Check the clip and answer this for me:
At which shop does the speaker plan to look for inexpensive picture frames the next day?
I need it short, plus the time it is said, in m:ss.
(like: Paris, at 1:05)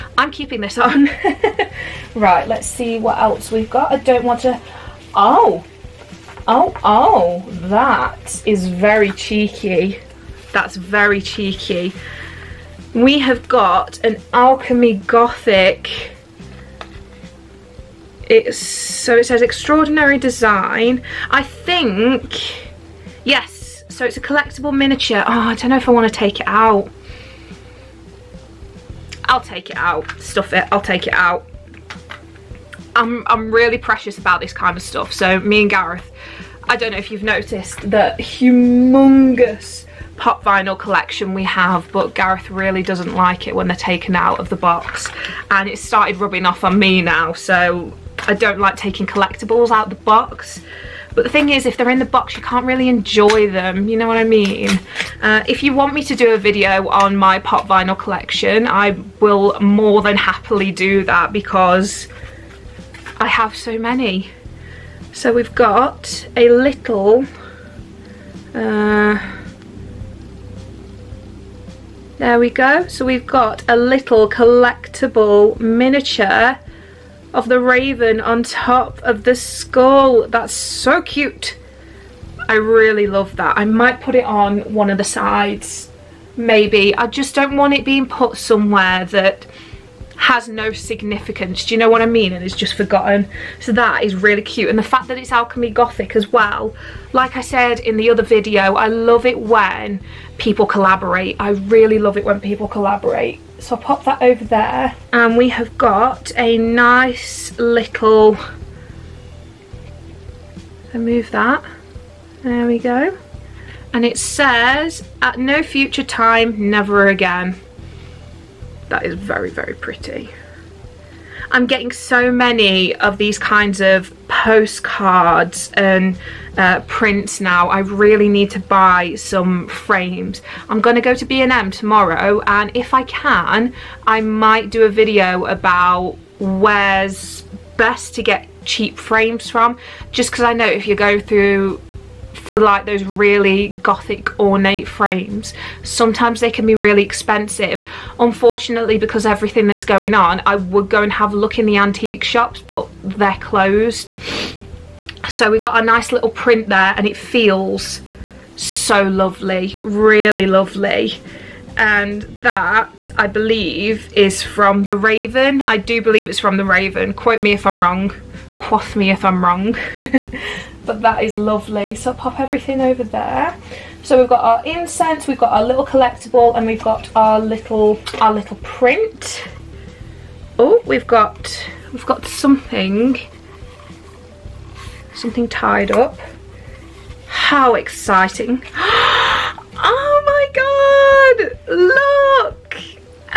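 B&M, at 2:11.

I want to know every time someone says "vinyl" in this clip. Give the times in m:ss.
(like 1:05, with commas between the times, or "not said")
0:40, 0:57.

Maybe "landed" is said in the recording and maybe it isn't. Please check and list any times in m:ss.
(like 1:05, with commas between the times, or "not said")
not said.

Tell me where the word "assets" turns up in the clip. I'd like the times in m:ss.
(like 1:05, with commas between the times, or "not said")
not said.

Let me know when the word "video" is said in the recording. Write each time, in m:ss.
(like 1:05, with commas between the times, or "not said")
0:56, 1:38, 2:14.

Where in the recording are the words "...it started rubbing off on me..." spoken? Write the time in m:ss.
0:45.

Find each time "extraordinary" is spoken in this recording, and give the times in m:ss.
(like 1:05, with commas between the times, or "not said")
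0:19.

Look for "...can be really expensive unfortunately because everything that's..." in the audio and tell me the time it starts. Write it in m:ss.
2:26.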